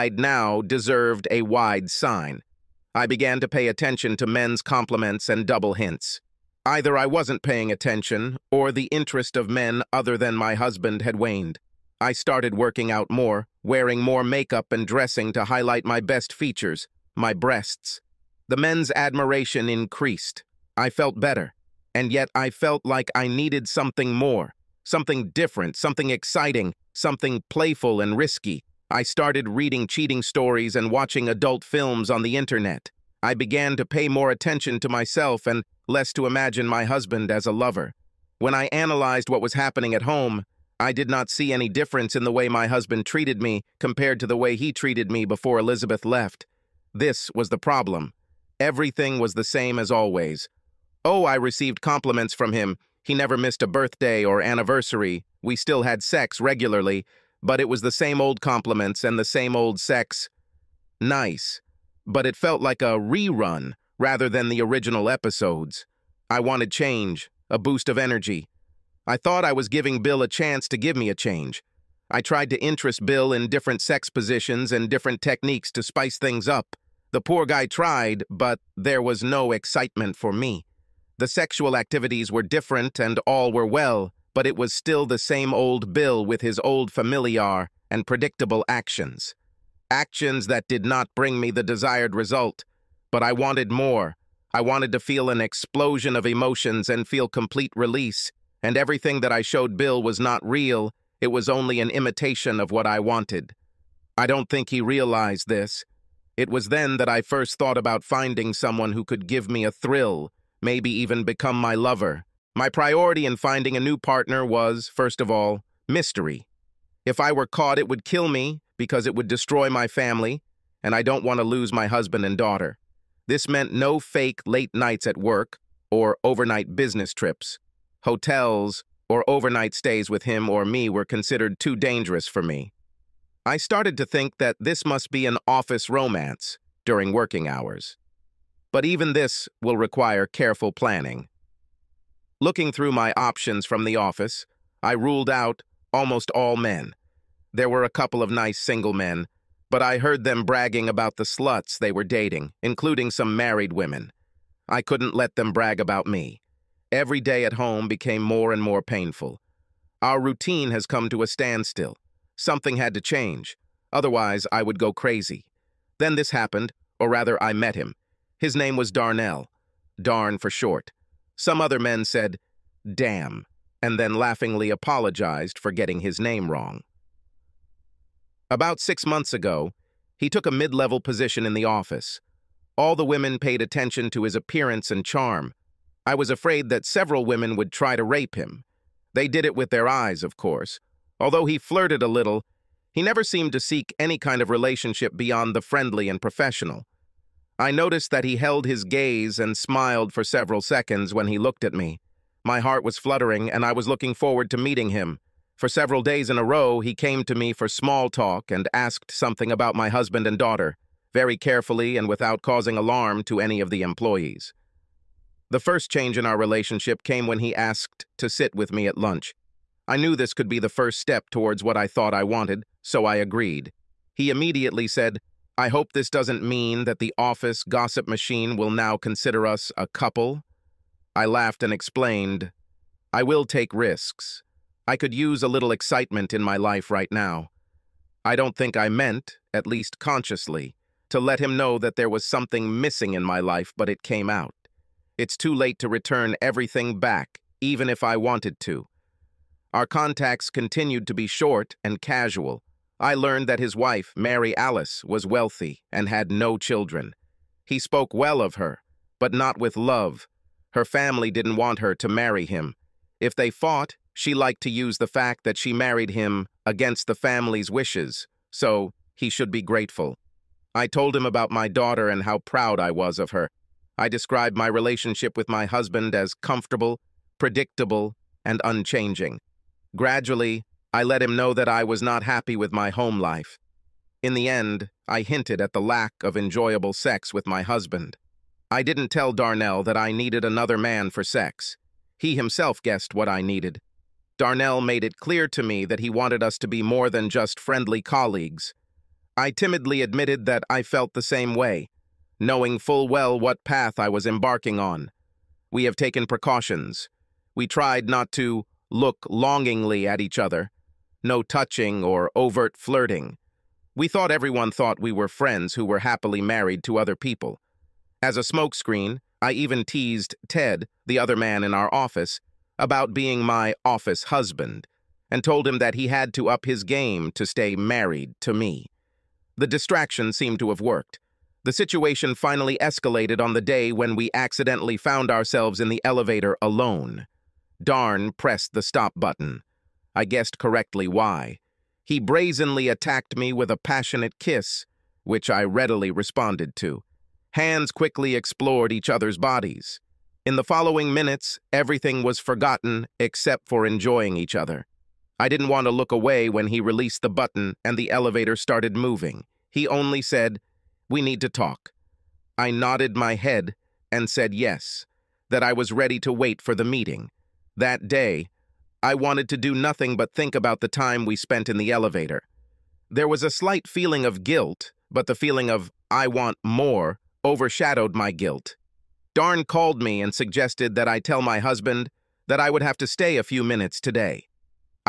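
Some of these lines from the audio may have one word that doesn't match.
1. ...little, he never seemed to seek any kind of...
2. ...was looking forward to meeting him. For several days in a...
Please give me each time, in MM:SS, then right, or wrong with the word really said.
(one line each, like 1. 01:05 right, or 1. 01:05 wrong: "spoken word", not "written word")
1. 03:12 right
2. 03:23 right.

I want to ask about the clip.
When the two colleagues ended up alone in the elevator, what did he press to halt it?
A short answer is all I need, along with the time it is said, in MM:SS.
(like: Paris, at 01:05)
The stop button, at 05:38.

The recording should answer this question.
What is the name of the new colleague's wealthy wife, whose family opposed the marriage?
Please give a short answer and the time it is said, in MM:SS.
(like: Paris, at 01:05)
Mary Alice, at 04:14.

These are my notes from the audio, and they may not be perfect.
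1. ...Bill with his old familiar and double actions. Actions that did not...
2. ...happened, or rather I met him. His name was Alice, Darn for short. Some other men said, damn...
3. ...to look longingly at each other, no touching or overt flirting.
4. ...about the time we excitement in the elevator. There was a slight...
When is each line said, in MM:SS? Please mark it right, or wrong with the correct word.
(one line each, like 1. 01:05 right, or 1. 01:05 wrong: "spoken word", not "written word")
1. 01:25 wrong: "predictable", not "double"
2. 02:46 wrong: "Darnell", not "Alice"
3. 05:08 right
4. 06:10 wrong: "spent", not "excitement".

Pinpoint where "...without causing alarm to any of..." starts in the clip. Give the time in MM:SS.
03:32.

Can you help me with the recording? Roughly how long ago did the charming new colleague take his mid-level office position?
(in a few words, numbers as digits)
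6 months.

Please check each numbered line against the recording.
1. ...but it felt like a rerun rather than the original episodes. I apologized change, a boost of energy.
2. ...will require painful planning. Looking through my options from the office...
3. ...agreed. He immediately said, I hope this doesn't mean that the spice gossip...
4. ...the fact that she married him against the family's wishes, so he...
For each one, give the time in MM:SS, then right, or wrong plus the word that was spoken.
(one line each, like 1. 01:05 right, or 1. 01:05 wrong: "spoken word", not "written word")
1. 01:02 wrong: "wanted", not "apologized"
2. 02:19 wrong: "careful", not "painful"
3. 03:43 wrong: "office", not "spice"
4. 04:24 right.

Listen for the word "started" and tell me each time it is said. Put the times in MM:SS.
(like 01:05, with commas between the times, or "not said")
00:12, 00:29, 02:13, 05:58.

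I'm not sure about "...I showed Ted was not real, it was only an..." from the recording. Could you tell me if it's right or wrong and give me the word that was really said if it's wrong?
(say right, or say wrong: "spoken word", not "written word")
wrong: "Bill", not "Ted".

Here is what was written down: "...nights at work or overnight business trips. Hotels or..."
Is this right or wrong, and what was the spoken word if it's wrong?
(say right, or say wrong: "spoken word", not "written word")
right.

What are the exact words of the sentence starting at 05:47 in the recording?
Hands quickly explored each other's bodies.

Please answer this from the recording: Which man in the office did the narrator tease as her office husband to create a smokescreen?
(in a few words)
Ted.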